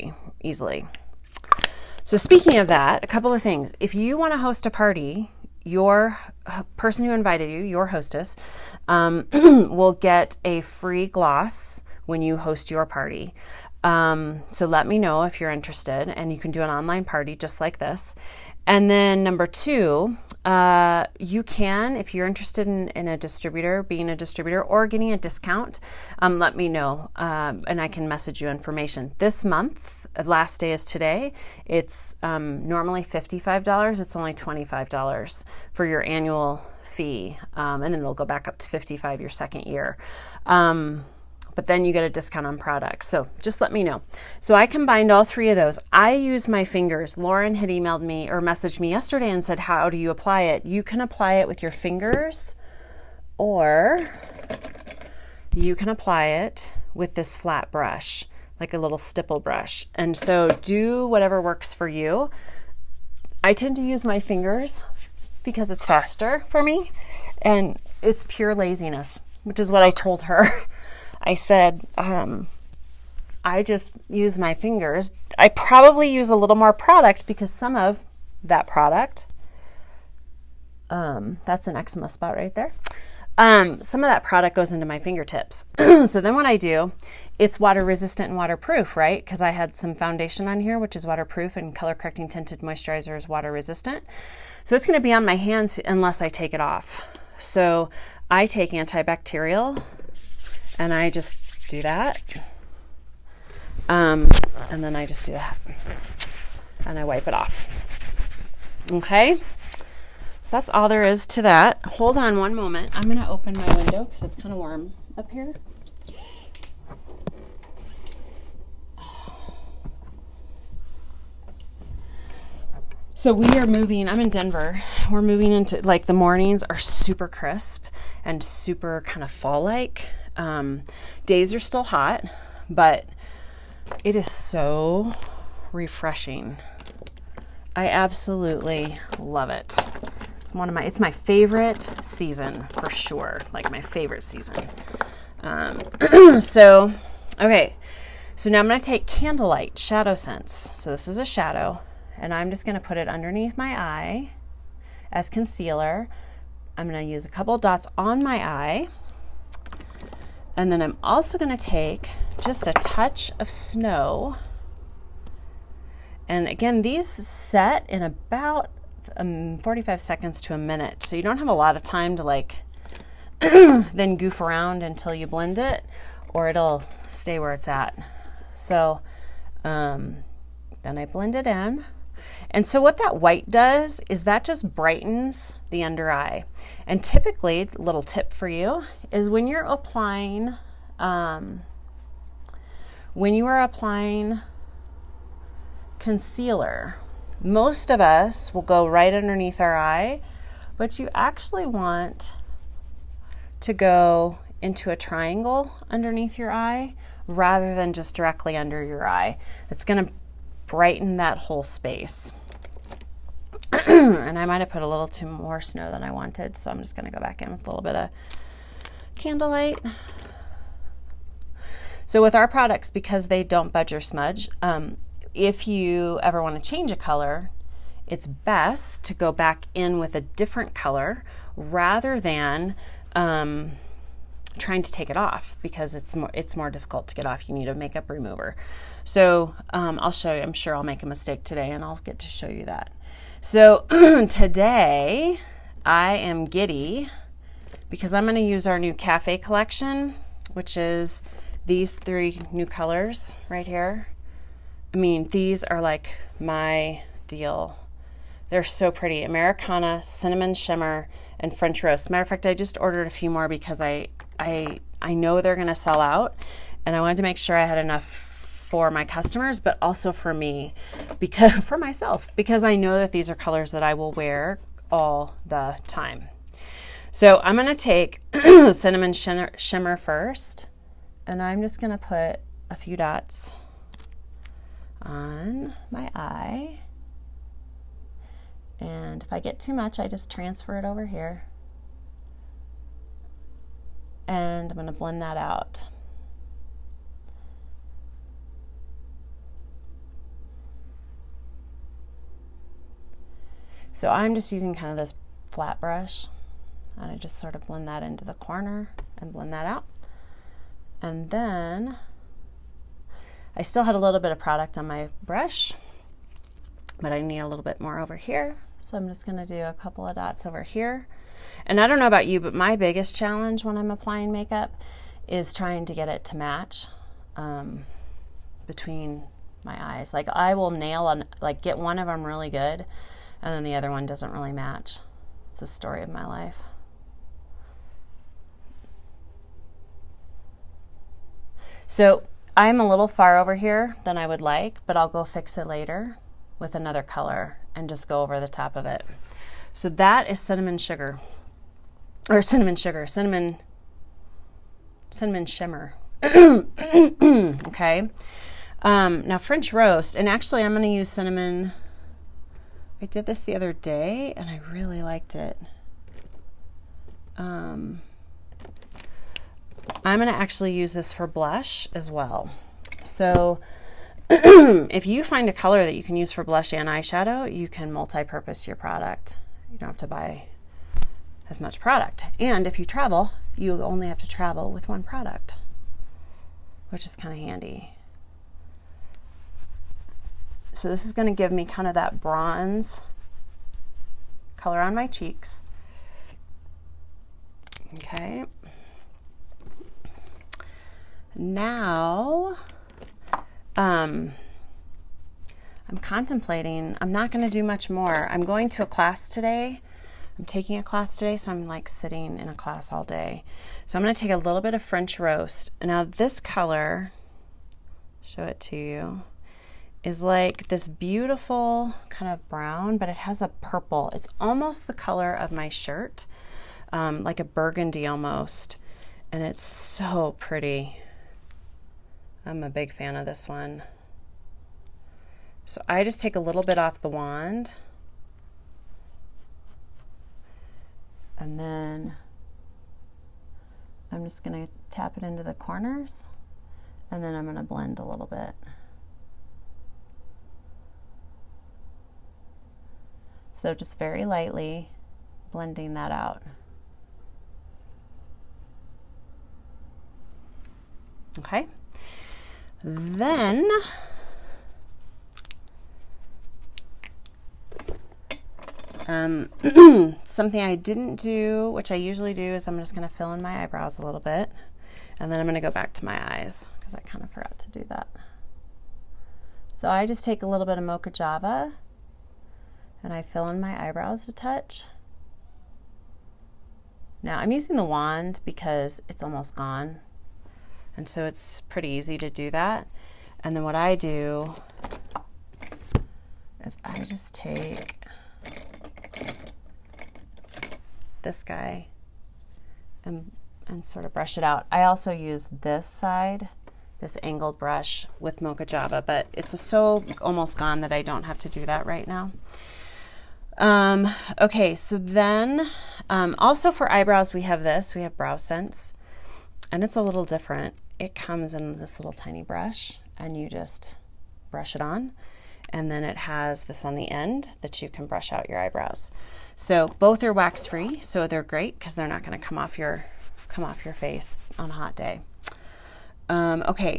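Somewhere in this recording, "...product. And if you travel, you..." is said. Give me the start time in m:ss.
6:21.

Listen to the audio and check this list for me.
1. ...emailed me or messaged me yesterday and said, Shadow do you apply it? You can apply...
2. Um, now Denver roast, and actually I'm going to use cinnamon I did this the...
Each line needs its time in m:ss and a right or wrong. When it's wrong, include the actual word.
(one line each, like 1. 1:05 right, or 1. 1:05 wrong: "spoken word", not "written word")
1. 0:47 wrong: "How", not "Shadow"
2. 5:58 wrong: "French", not "Denver".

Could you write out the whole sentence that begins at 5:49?
So that is cinnamon sugar, or cinnamon sugar, cinnamon, cinnamon shimmer.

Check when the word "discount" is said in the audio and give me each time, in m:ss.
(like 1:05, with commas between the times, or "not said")
0:25, 0:42.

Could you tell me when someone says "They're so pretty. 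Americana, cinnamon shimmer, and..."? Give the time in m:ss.
4:18.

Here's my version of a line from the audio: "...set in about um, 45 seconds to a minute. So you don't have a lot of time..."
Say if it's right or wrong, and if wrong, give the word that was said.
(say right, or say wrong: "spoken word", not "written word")
right.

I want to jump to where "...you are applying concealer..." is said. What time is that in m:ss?
3:13.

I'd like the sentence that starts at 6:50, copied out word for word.
I'm taking a class today, so I'm like sitting in a class all day.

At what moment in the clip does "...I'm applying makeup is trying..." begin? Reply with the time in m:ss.
5:23.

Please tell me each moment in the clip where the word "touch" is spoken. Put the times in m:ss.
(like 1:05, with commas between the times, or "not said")
2:42, 8:04.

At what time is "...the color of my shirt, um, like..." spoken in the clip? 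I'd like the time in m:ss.
7:04.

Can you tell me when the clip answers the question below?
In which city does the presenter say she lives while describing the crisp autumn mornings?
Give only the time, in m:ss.
2:04.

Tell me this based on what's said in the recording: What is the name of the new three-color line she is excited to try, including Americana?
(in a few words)
cafe collection.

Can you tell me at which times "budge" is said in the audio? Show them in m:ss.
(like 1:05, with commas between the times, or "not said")
3:43.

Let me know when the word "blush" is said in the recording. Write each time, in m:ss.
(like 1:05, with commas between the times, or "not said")
6:11, 6:16.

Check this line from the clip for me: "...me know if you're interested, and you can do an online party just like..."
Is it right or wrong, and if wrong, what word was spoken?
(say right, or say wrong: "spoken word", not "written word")
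right.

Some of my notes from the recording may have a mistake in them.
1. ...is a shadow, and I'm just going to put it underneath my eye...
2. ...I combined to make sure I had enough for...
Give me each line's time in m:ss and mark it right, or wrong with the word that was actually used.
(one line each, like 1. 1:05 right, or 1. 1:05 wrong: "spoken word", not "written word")
1. 2:31 right
2. 4:26 wrong: "wanted", not "combined".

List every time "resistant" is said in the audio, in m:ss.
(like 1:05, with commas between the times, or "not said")
1:27, 1:33.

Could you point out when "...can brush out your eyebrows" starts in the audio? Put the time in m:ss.
8:47.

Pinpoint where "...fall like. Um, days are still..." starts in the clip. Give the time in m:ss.
2:09.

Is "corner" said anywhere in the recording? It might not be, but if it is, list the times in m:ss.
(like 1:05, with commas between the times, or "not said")
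5:08, 7:25.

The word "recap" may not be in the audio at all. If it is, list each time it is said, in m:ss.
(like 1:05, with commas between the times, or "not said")
not said.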